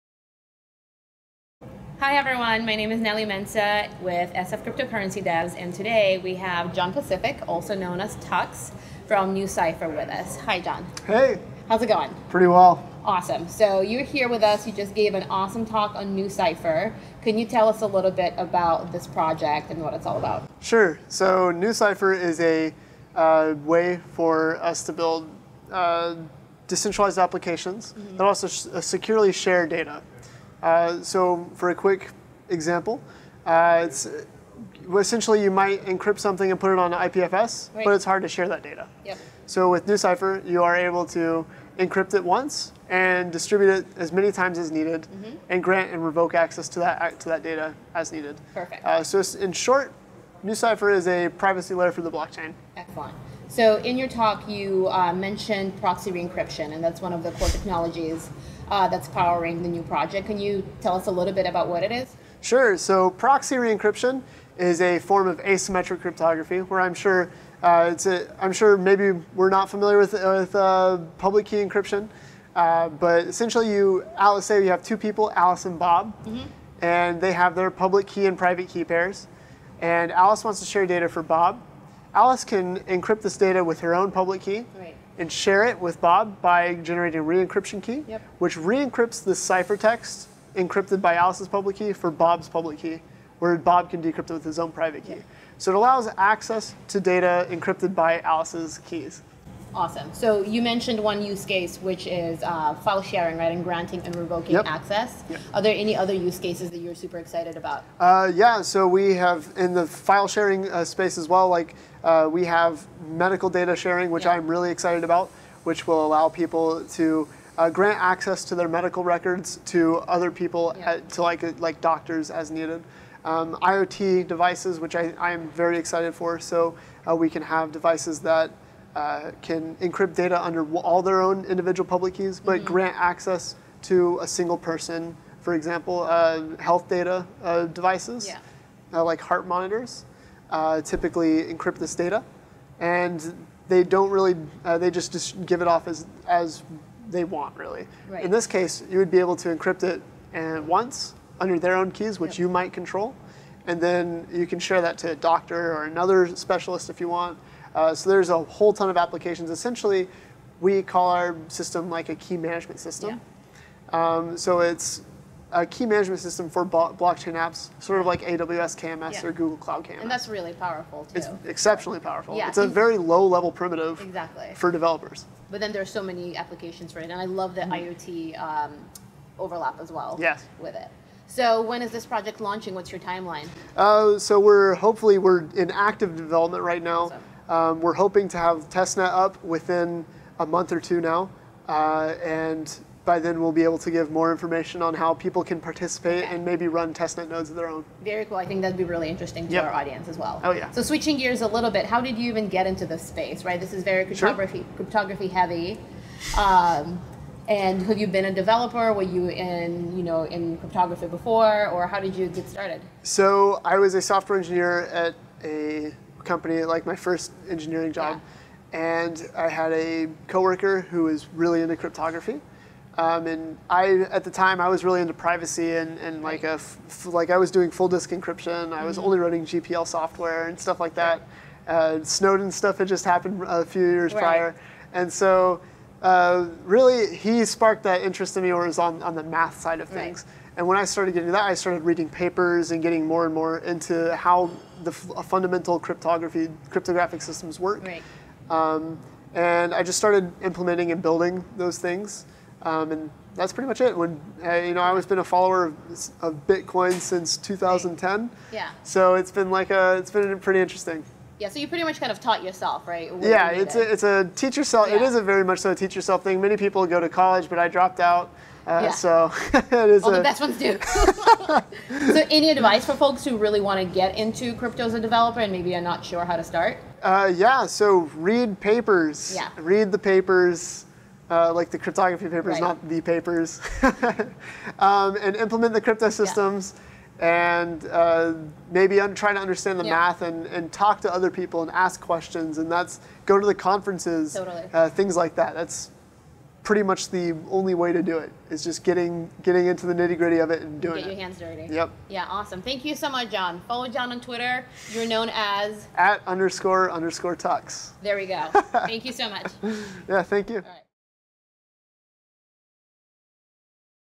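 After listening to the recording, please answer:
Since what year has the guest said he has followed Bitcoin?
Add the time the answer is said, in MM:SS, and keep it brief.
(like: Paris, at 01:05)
2010, at 04:17.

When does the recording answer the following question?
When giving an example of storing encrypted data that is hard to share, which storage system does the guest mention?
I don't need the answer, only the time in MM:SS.
00:36.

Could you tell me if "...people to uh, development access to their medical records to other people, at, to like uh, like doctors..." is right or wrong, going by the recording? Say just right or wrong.
wrong.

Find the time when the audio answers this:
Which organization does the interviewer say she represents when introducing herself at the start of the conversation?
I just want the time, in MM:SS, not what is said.
00:04.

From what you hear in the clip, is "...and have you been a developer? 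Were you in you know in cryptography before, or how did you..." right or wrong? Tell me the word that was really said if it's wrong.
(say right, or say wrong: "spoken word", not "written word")
right.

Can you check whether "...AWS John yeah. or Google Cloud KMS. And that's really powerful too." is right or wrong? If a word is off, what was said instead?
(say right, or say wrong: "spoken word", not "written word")
wrong: "KMS", not "John".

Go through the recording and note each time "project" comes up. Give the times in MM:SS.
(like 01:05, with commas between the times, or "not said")
00:19, 00:59, 03:02.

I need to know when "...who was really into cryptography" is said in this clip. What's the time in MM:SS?
03:40.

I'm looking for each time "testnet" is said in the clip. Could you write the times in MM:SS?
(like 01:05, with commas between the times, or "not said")
03:08, 03:16.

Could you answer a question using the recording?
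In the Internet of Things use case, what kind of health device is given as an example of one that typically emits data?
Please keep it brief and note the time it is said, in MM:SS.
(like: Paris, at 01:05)
Heart monitors, at 02:19.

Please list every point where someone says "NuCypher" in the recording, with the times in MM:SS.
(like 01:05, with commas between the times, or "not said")
00:09, 00:16, 00:21, 00:39, 00:50.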